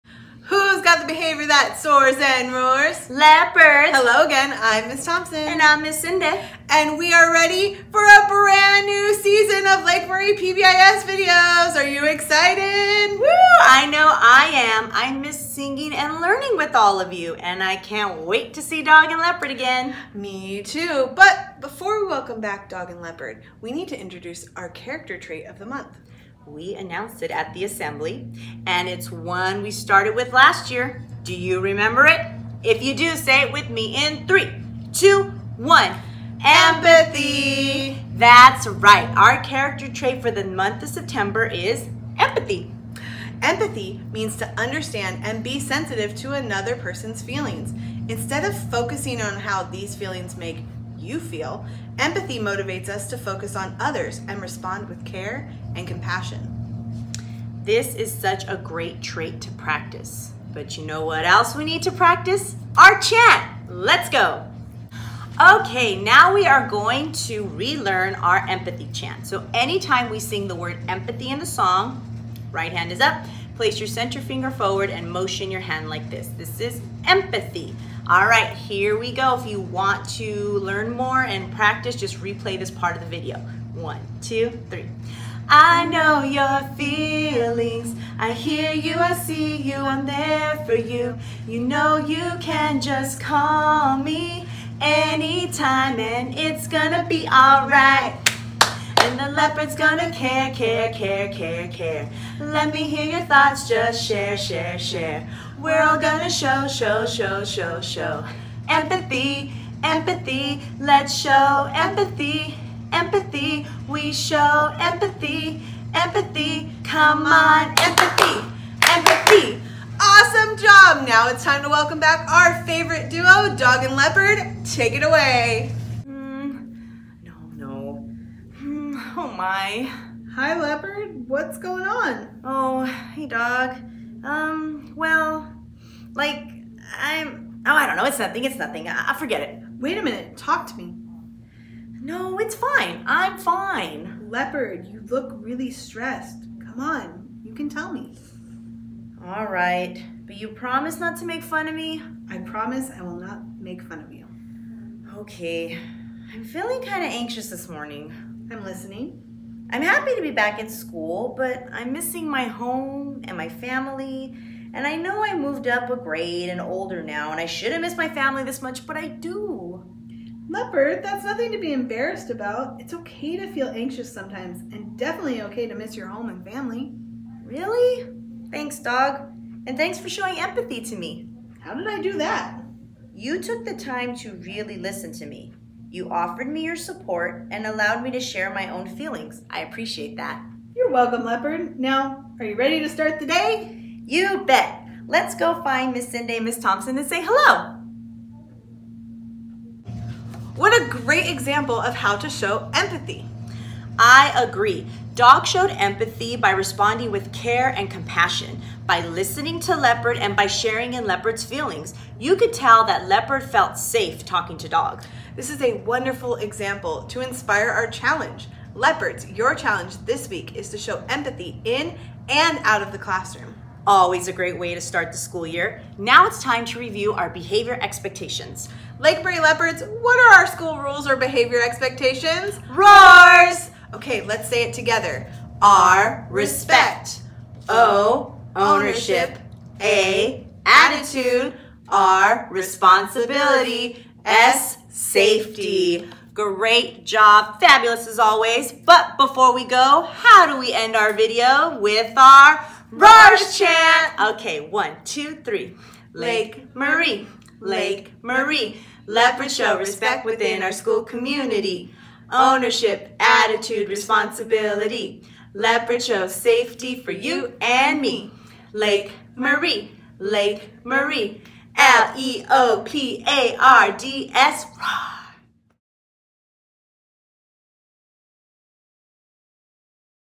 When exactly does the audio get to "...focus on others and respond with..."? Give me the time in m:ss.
0:53.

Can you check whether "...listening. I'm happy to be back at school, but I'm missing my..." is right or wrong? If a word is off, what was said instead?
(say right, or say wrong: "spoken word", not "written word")
right.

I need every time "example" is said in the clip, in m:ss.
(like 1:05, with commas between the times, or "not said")
3:21, 3:36.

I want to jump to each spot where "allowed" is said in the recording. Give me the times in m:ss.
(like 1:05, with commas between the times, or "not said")
3:07.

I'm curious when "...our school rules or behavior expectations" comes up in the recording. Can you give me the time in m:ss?
3:50.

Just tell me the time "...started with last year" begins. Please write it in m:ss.
0:29.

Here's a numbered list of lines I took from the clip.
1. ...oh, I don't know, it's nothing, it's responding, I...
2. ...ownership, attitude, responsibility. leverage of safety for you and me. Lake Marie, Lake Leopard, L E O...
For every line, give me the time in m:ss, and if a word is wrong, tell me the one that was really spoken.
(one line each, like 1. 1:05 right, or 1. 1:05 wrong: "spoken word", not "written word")
1. 2:17 wrong: "nothing", not "responding"
2. 4:22 wrong: "Marie", not "Leopard".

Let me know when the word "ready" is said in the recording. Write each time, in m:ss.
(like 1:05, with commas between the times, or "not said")
0:07, 3:12.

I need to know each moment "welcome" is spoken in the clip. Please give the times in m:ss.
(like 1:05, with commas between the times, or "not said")
0:22, 2:01, 3:10.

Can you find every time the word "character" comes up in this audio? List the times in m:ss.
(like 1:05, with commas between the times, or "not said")
0:24, 0:39.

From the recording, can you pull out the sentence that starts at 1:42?
Let me hear your thoughts, just share, share, share.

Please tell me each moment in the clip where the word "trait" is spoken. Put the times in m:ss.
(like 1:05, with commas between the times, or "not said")
0:25, 0:39, 0:59.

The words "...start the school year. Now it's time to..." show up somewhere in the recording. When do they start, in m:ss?
3:44.